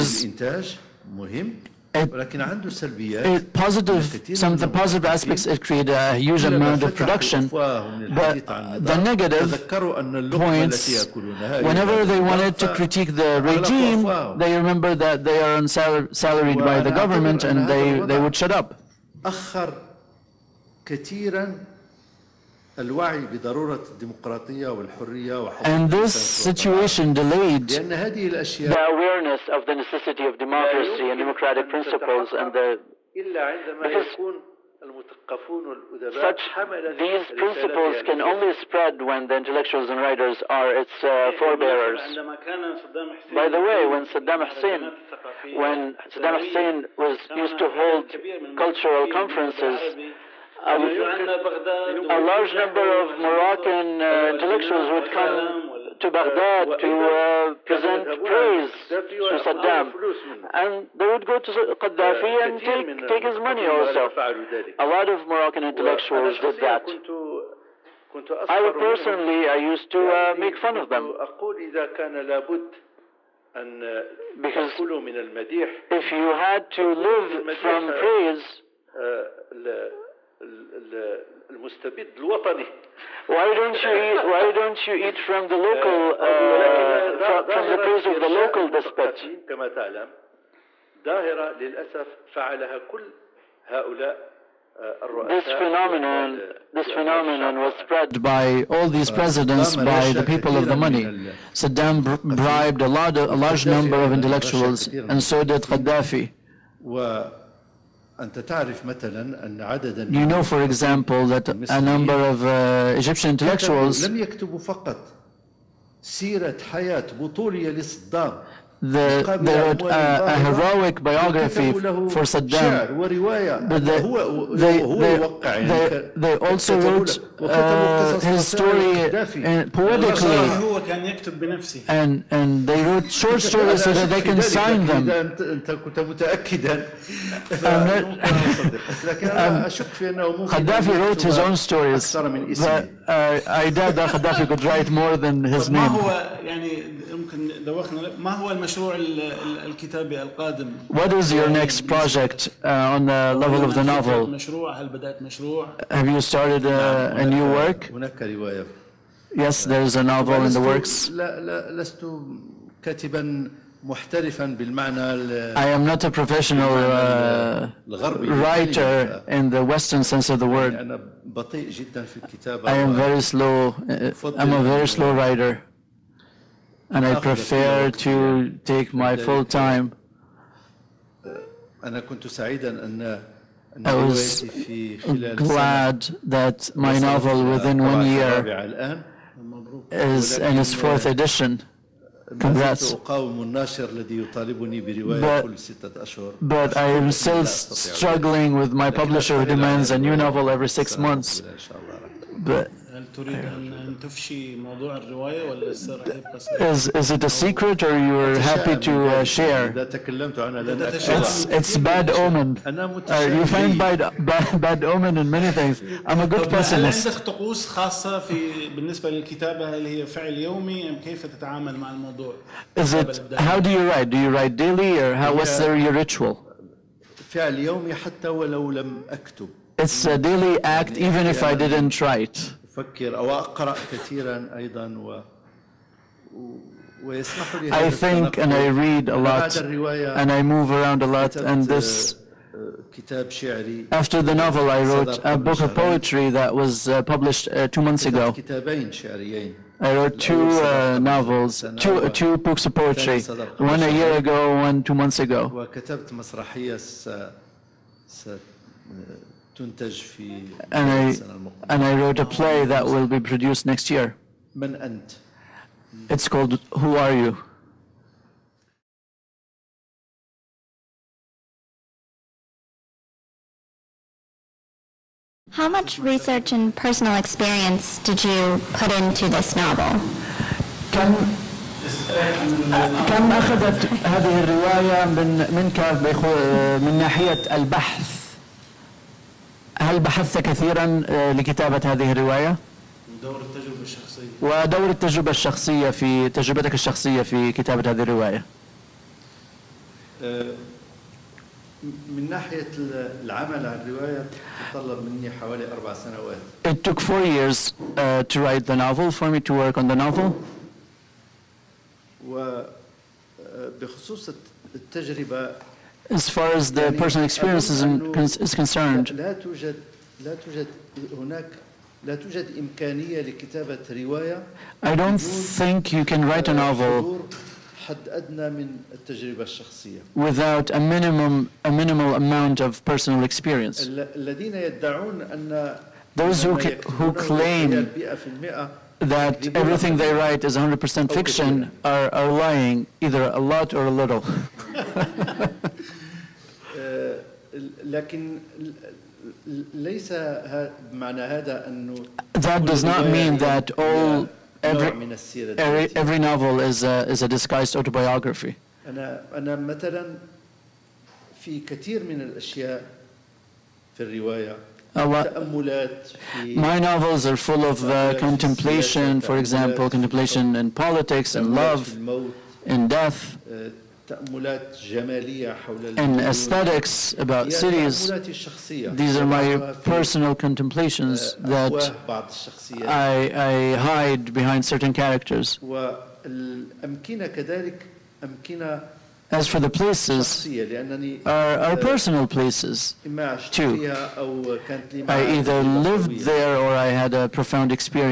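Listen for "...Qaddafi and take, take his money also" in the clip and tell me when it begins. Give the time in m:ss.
1:01.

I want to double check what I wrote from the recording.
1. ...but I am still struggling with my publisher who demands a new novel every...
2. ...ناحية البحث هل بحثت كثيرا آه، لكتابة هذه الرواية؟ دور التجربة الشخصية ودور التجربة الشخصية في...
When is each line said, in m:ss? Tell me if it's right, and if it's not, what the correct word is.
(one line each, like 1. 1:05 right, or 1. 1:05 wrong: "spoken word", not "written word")
1. 3:16 right
2. 4:46 right.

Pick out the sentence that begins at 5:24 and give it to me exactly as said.
I don't think you can write a novel without a minimum a minimal amount of personal experience.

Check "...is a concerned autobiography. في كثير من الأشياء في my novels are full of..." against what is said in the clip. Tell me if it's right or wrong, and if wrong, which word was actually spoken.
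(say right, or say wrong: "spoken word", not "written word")
wrong: "disguised", not "concerned".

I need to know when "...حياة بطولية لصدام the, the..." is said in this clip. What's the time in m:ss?
1:56.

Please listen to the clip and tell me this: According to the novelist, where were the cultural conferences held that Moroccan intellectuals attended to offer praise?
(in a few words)
Baghdad.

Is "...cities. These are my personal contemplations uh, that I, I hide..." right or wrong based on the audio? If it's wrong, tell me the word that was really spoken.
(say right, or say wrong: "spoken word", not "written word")
right.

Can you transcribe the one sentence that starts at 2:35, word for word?
Have you started a, uh, a new work?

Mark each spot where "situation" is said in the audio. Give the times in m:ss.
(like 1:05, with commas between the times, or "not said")
0:26.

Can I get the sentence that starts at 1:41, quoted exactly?
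Saddam bribed a, large, a large number of intellectuals, and so did Gaddafi.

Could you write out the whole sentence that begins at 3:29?
إذا تكلمت لن It's it's bad omen.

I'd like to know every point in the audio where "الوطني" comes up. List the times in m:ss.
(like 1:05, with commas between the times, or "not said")
1:22.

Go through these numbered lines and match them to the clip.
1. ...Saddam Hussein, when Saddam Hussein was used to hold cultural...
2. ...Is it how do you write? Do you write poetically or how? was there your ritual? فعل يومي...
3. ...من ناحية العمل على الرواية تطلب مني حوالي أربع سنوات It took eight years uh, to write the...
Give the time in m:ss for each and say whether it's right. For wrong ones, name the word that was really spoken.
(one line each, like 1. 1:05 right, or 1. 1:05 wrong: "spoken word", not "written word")
1. 0:44 right
2. 3:42 wrong: "daily", not "poetically"
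3. 5:01 wrong: "four", not "eight".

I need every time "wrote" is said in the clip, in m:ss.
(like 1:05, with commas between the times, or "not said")
2:06, 2:12, 2:20, 4:04, 4:09, 4:21.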